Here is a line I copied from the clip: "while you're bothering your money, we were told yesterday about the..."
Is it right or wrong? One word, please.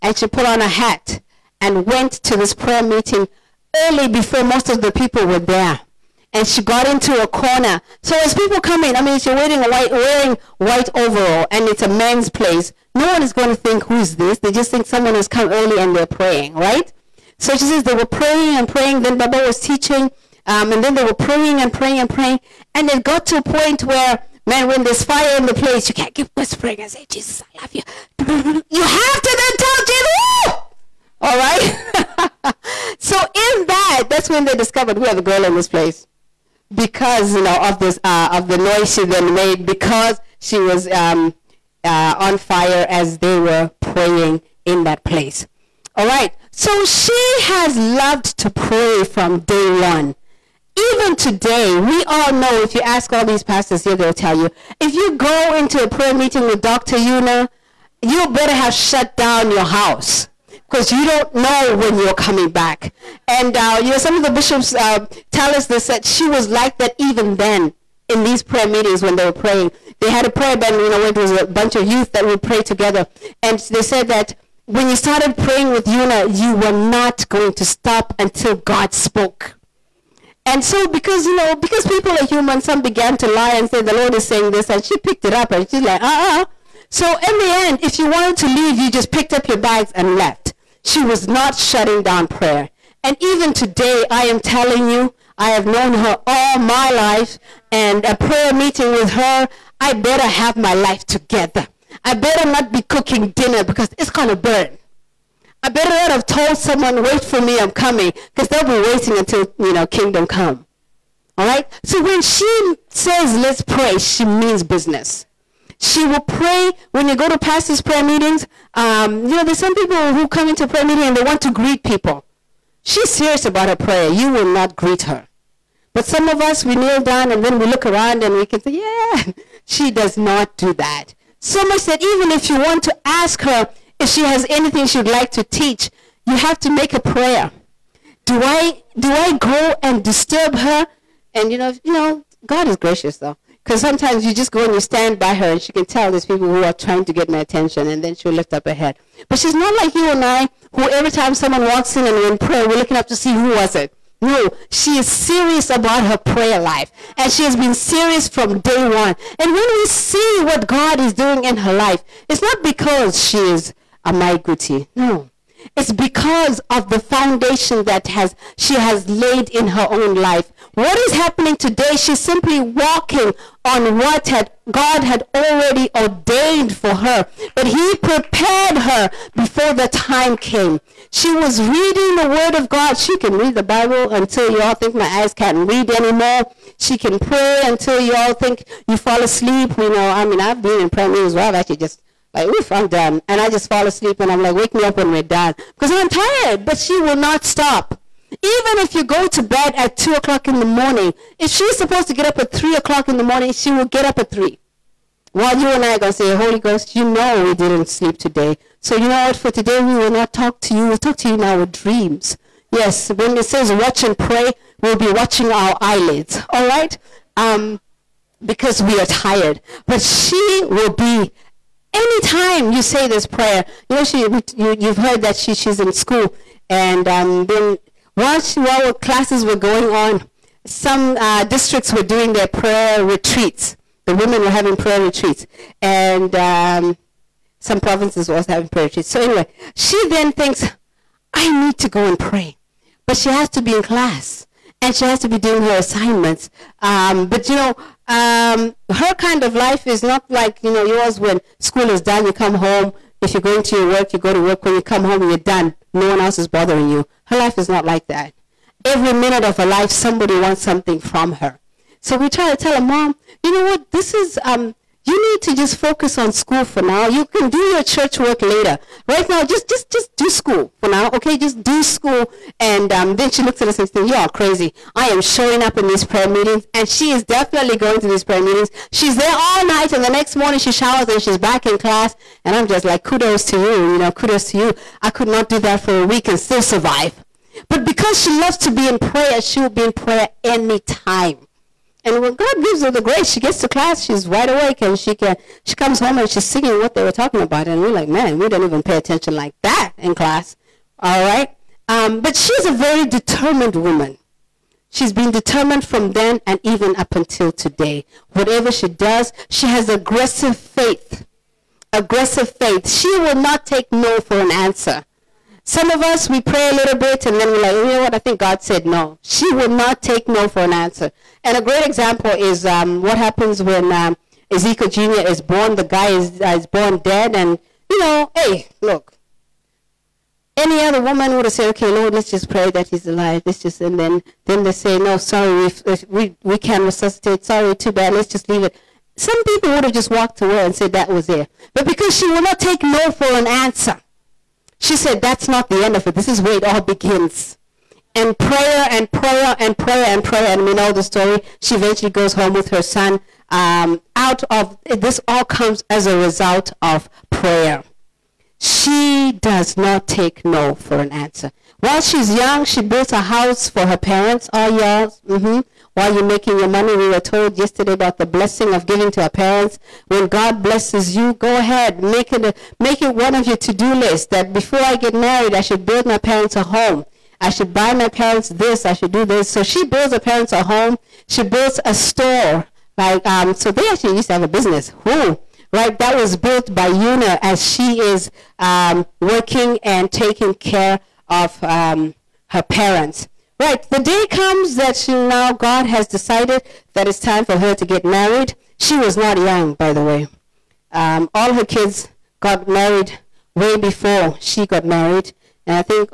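wrong.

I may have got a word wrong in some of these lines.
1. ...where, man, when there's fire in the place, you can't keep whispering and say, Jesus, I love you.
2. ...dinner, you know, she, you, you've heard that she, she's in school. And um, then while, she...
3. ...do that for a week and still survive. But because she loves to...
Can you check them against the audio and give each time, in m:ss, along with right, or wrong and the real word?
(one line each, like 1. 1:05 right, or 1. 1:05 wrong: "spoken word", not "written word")
1. 0:23 right
2. 3:43 wrong: "prayer", not "dinner"
3. 4:45 right.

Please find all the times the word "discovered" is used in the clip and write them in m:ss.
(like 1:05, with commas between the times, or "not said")
0:34.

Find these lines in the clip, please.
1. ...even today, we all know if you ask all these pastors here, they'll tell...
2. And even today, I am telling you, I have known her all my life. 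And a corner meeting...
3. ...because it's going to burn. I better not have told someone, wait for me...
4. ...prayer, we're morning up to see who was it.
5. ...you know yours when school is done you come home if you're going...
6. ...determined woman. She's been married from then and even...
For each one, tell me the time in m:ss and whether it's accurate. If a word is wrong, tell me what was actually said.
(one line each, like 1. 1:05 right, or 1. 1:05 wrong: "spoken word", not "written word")
1. 0:50 right
2. 1:33 wrong: "prayer", not "corner"
3. 1:43 right
4. 2:32 wrong: "looking", not "morning"
5. 4:10 right
6. 5:03 wrong: "determined", not "married".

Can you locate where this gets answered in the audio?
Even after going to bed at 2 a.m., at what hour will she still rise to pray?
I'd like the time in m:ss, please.
3:22.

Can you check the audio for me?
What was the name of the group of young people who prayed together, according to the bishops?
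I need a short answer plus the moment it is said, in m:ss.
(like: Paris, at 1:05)
Prayer band, at 1:10.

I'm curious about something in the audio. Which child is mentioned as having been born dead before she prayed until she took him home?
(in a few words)
Ezekiel Jr.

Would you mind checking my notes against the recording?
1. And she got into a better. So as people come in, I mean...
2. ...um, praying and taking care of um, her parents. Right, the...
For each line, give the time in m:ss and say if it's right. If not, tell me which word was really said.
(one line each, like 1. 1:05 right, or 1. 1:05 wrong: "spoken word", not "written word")
1. 0:06 wrong: "corner", not "better"
2. 6:28 wrong: "working", not "praying".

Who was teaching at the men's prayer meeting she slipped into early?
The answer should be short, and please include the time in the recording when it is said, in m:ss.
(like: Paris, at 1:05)
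Baba, at 0:19.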